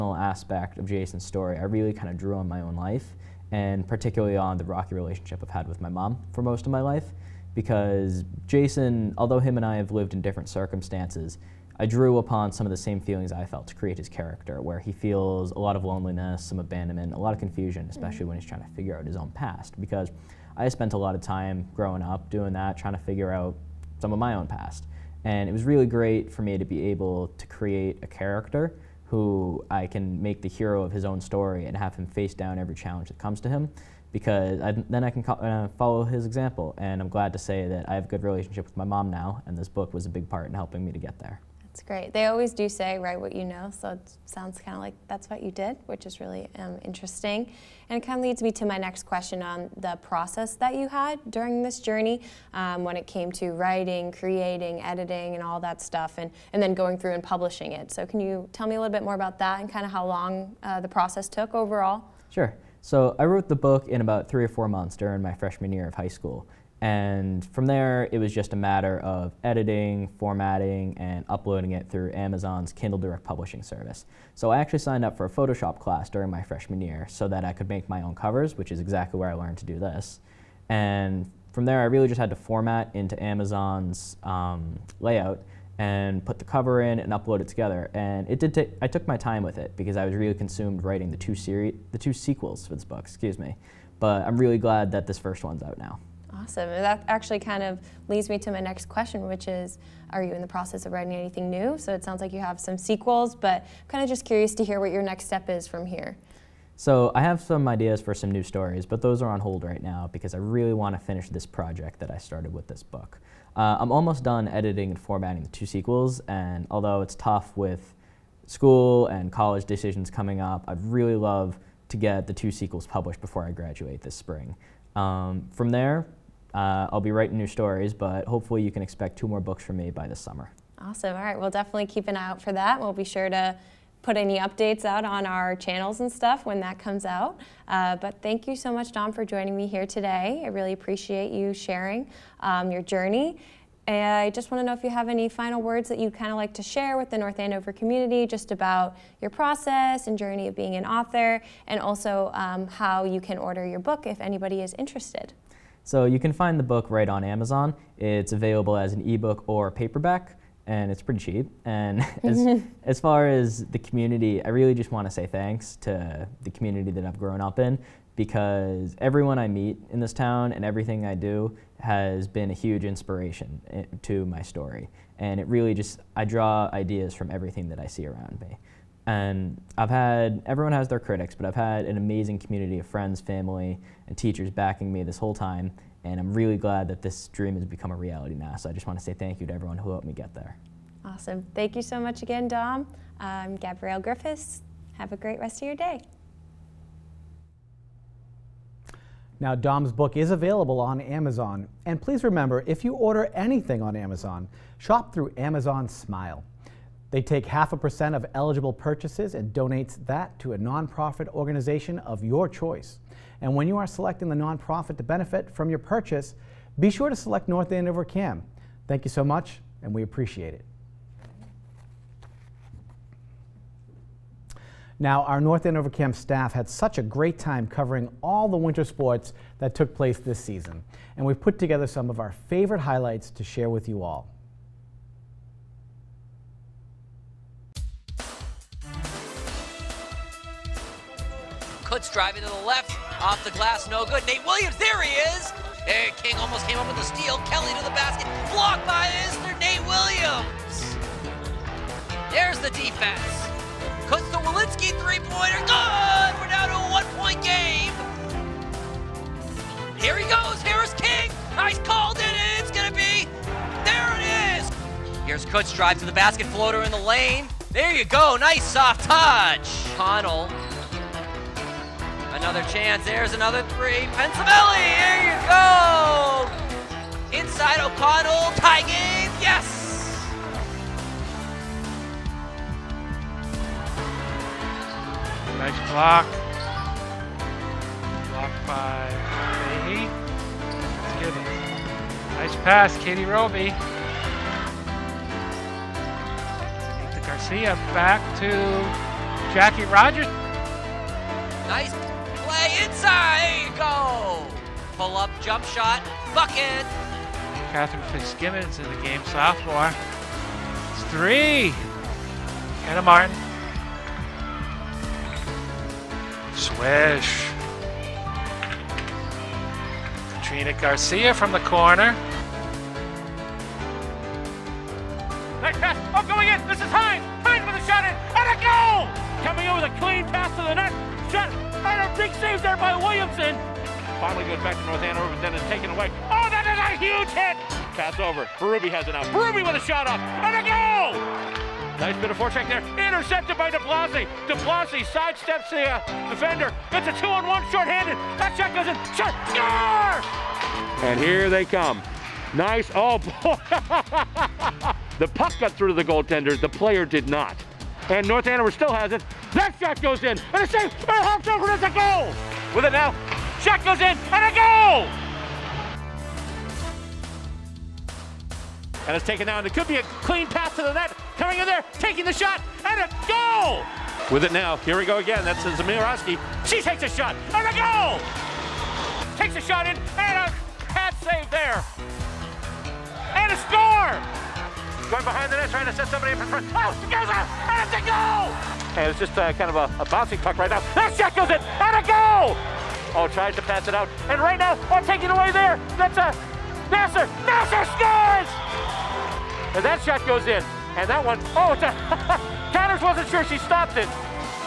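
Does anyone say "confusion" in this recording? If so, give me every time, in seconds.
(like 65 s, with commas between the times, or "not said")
17 s.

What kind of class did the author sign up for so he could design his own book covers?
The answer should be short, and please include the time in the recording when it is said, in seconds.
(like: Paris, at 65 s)
Photoshop, at 75 s.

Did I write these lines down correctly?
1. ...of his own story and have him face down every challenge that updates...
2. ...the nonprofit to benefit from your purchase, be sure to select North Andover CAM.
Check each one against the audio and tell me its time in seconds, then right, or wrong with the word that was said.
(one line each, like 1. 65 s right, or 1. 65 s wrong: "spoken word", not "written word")
1. 30 s wrong: "comes", not "updates"
2. 214 s right.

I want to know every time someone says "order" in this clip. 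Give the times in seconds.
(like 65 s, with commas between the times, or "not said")
153 s, 202 s.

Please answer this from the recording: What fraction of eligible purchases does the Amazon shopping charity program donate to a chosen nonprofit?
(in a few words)
half a percent.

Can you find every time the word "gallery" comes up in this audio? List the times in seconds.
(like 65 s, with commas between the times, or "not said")
not said.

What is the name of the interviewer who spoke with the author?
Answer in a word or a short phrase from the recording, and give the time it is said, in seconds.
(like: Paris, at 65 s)
Gabrielle Griffiths, at 193 s.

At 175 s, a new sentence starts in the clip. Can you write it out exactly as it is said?
And it really just, I draw ideas from everything that I see around me.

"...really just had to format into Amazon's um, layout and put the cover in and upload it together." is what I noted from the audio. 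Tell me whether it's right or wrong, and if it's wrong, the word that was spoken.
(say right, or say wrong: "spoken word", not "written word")
right.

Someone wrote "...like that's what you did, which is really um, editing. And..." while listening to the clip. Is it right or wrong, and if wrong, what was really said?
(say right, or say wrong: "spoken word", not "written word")
wrong: "interesting", not "editing".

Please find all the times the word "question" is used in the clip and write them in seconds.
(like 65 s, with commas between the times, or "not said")
49 s, 98 s.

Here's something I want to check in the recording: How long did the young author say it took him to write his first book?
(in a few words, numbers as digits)
3 or 4 months.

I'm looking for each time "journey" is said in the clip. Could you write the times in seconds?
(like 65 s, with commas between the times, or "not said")
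51 s, 142 s, 150 s.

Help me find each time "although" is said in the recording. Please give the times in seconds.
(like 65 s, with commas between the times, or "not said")
9 s, 116 s.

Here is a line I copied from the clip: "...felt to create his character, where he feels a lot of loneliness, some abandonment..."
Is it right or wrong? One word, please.
right.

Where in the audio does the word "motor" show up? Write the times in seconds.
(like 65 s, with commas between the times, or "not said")
not said.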